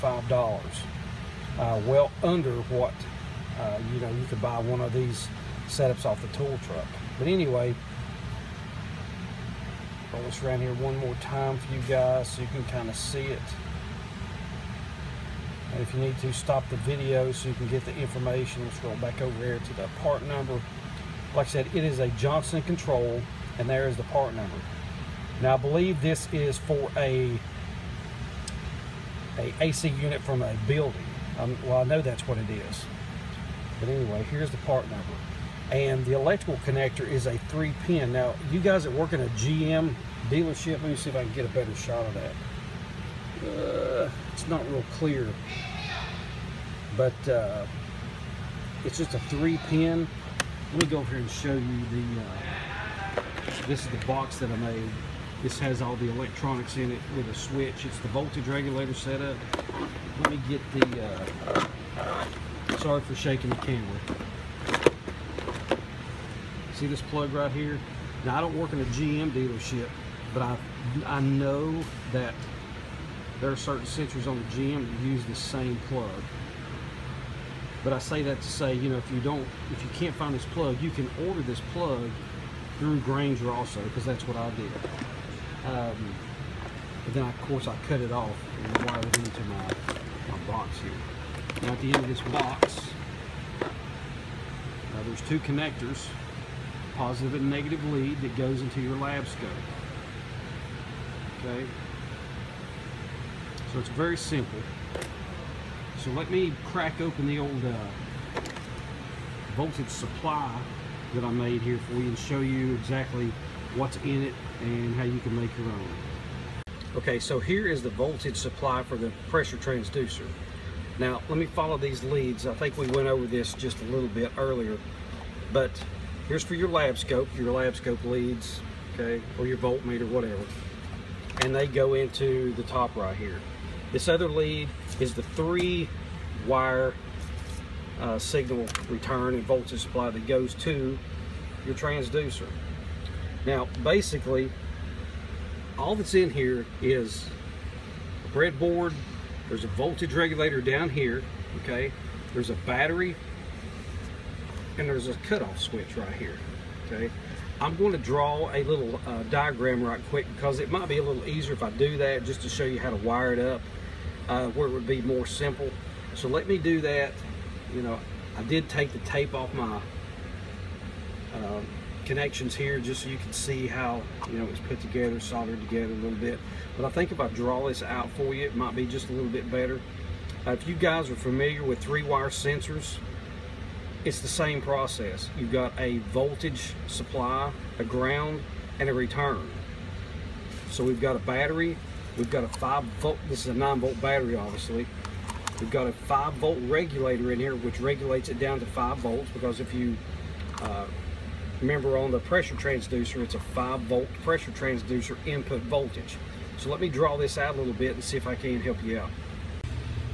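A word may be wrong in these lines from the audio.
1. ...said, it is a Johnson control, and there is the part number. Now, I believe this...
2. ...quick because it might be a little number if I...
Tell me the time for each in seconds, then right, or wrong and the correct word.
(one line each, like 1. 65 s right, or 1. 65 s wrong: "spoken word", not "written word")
1. 21 s right
2. 160 s wrong: "easier", not "number".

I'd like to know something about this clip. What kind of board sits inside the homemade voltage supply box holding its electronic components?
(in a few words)
Breadboard.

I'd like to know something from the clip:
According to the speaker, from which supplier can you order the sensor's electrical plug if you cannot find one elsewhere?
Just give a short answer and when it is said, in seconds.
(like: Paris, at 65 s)
Grainger, at 82 s.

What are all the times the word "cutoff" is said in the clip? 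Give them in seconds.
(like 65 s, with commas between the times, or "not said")
155 s.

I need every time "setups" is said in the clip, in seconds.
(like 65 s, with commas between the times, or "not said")
5 s, 58 s.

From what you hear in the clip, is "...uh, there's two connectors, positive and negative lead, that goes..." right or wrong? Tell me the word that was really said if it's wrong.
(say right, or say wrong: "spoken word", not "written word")
right.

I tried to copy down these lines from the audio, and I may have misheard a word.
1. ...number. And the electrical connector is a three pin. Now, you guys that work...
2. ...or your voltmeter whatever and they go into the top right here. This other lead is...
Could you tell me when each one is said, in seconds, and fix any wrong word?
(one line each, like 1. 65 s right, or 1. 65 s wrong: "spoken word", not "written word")
1. 34 s right
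2. 129 s right.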